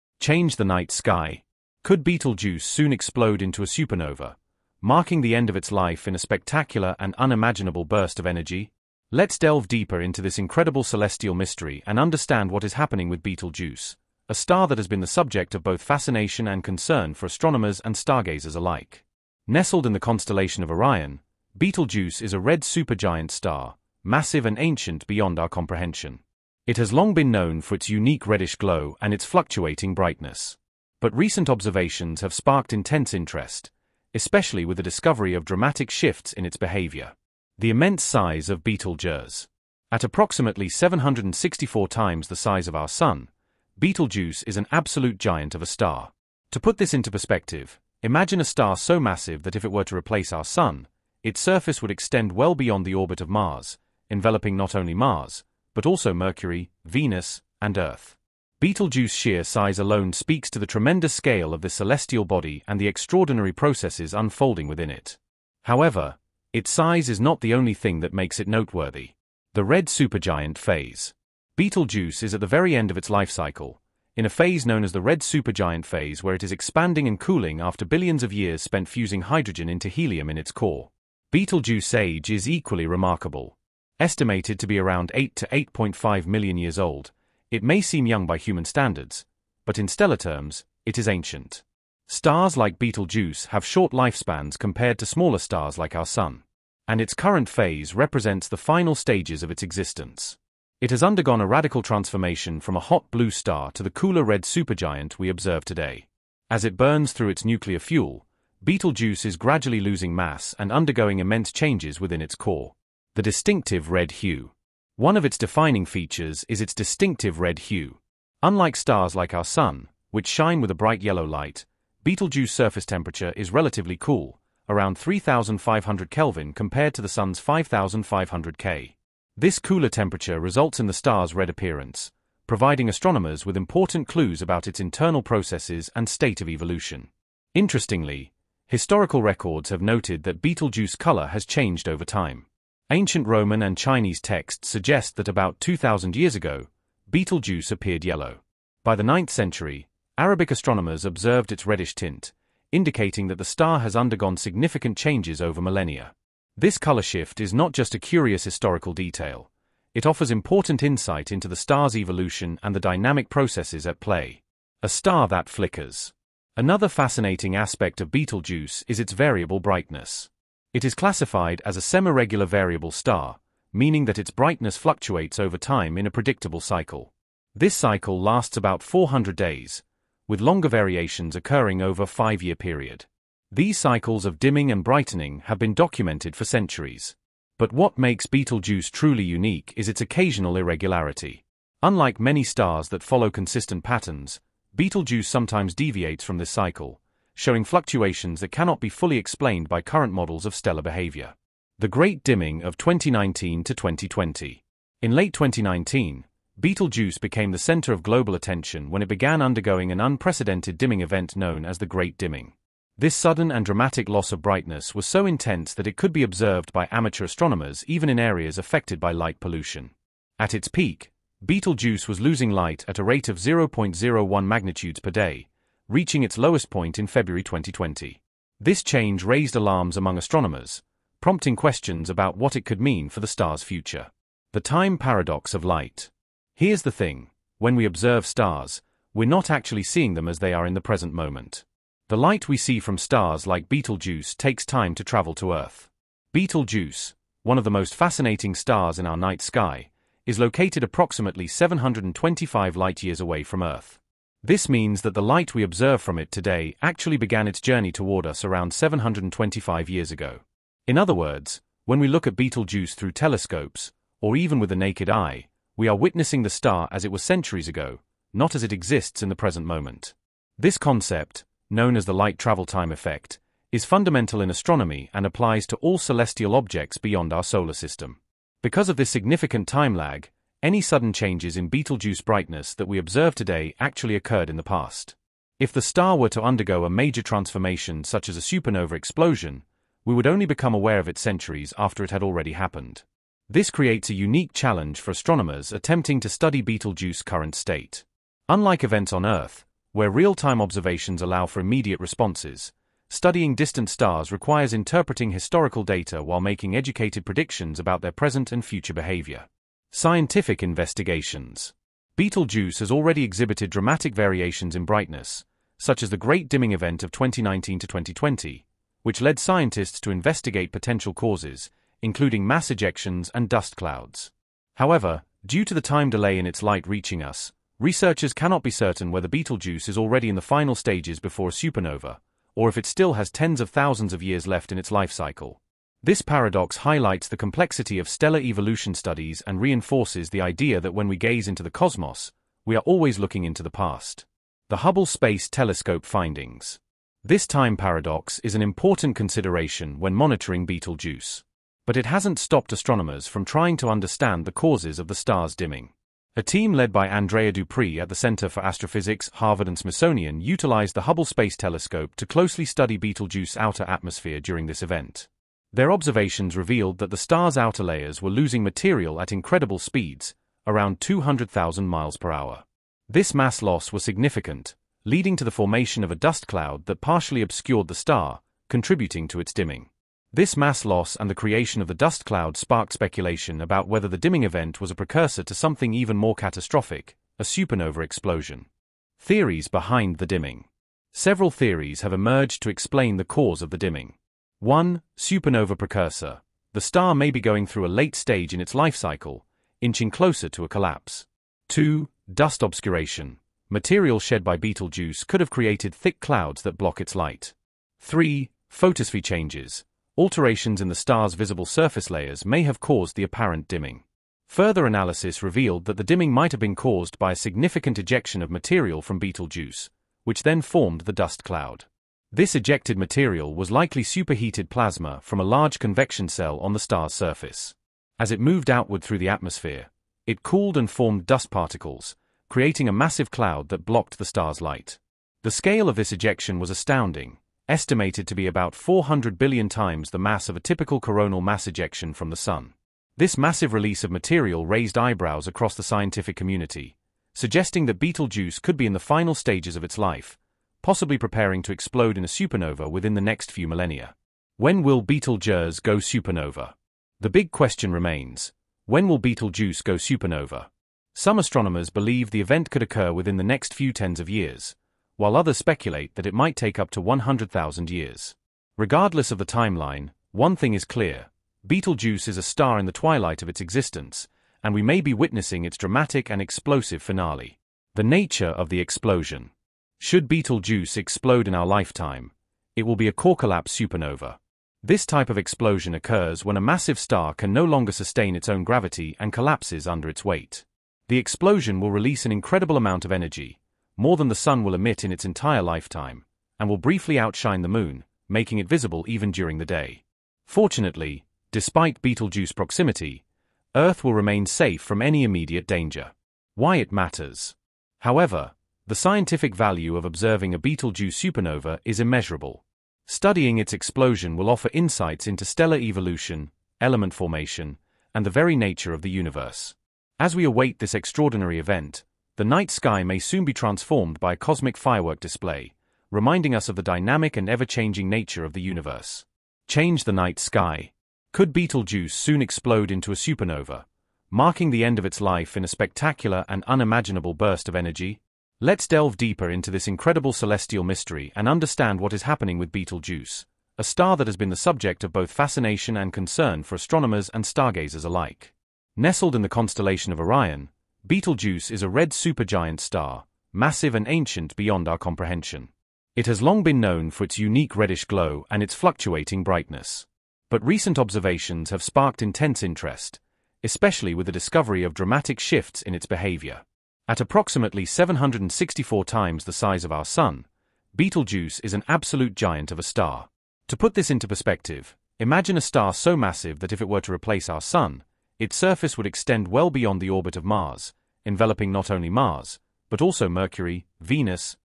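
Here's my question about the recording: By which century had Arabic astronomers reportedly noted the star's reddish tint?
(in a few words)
9th century.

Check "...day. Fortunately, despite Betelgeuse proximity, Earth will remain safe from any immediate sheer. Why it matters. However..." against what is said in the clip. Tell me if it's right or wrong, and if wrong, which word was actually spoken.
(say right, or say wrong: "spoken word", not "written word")
wrong: "danger", not "sheer".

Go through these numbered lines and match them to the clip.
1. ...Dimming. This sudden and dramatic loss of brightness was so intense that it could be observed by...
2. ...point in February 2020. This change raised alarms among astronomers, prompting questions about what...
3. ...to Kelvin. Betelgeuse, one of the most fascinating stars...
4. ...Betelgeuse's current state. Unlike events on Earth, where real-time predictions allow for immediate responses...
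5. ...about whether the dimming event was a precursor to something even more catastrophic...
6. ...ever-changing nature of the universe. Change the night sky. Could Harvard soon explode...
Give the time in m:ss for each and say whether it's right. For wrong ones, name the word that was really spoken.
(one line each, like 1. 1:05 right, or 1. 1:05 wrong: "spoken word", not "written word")
1. 3:32 right
2. 3:46 right
3. 4:05 wrong: "Earth", not "Kelvin"
4. 4:56 wrong: "observations", not "predictions"
5. 6:23 right
6. 8:47 wrong: "Betelgeuse", not "Harvard".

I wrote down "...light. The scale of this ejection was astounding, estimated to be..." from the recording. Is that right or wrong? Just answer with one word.
right.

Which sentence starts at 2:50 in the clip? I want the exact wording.
It is classified as a semiregular variable star, meaning that its brightness fluctuates over time in a predictable cycle.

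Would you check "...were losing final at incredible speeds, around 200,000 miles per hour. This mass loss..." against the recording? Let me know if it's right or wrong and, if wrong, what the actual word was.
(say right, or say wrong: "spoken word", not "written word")
wrong: "material", not "final".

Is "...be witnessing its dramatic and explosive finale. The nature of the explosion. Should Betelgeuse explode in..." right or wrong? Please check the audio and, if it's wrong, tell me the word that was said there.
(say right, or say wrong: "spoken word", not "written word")
right.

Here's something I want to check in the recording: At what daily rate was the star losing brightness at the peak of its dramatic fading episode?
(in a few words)
0.01 magnitudes per day.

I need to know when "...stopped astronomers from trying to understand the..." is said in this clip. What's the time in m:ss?
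5:52.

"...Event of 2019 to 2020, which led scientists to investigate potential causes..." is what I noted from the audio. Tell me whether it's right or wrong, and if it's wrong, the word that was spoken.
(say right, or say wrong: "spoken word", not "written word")
right.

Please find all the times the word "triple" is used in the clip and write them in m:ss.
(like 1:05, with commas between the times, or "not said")
not said.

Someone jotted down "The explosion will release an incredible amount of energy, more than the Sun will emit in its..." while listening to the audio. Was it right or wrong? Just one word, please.
right.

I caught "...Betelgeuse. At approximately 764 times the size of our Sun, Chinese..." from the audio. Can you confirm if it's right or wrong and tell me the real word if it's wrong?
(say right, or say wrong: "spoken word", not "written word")
wrong: "Betelgeuse", not "Chinese".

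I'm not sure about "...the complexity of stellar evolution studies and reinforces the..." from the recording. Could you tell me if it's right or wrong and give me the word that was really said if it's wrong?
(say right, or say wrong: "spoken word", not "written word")
right.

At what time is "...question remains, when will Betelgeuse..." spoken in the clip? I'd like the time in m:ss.
7:37.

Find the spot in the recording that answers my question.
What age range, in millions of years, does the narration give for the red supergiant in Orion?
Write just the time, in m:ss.
1:25.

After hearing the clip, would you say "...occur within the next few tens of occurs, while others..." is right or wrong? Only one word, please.
wrong.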